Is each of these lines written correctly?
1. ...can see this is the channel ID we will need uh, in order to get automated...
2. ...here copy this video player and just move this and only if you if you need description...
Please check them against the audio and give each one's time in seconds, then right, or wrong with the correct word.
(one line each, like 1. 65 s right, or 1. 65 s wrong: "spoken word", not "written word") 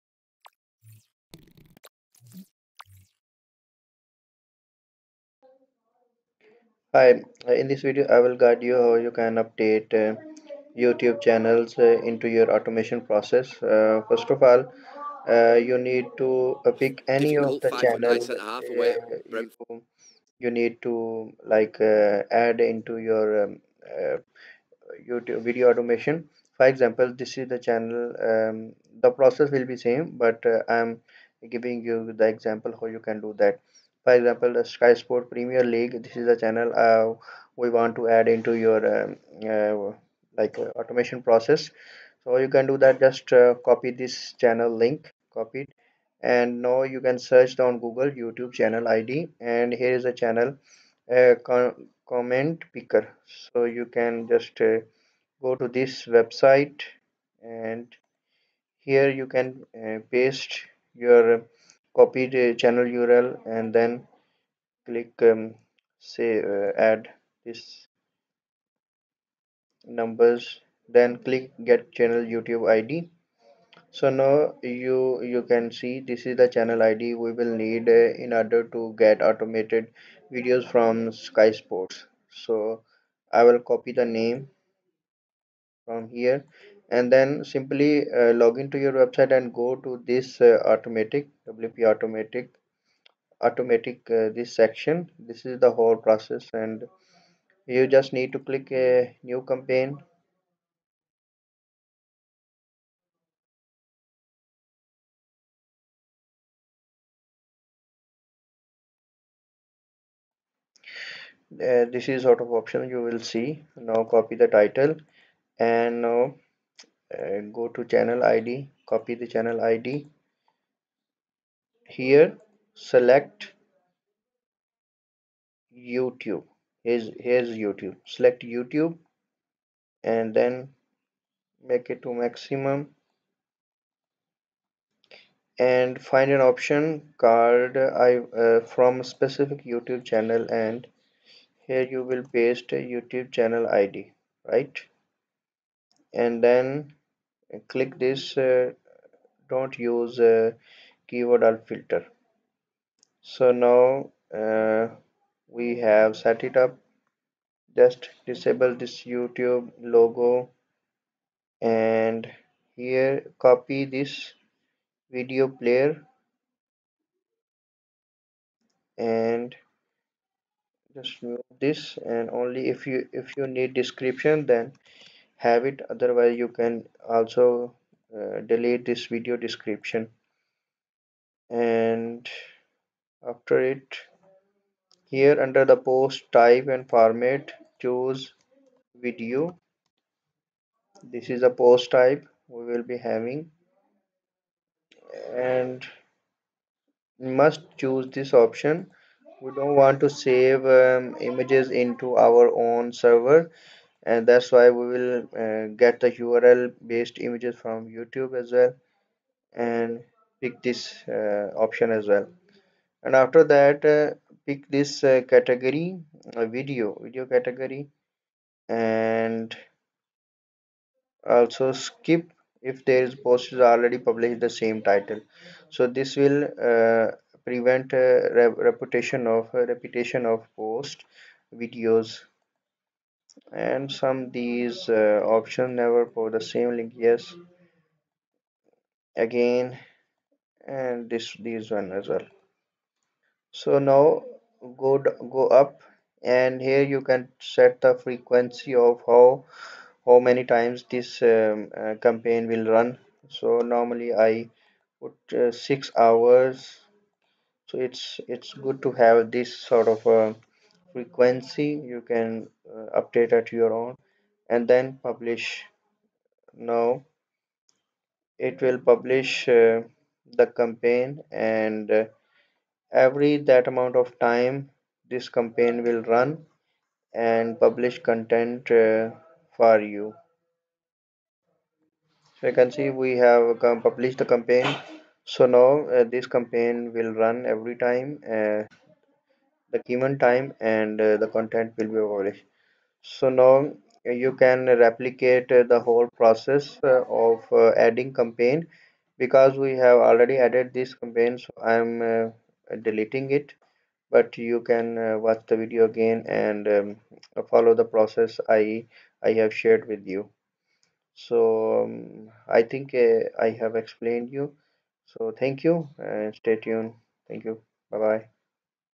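1. 75 s right
2. 162 s right.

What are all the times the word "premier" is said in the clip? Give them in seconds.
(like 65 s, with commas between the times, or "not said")
35 s.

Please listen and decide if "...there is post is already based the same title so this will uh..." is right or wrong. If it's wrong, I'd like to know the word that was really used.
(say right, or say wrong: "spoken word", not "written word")
wrong: "published", not "based".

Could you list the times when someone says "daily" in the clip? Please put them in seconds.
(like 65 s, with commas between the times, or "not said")
not said.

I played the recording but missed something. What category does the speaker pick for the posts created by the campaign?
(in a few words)
video category.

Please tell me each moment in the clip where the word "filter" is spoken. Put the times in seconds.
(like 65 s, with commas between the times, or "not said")
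151 s.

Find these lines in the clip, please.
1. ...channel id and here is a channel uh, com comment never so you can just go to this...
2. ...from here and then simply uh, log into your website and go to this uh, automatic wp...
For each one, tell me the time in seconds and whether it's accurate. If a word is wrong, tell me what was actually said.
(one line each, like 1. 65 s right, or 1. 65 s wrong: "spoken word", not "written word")
1. 48 s wrong: "picker", not "never"
2. 85 s right.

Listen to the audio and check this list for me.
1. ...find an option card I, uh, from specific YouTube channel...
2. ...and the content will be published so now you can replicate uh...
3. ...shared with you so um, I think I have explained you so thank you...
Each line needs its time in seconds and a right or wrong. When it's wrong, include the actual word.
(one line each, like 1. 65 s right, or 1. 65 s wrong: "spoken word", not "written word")
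1. 136 s right
2. 290 s right
3. 309 s right.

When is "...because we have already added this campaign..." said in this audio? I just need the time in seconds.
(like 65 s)
299 s.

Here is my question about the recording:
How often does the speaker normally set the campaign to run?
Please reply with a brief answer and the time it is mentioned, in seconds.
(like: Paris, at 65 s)
6 hours, at 255 s.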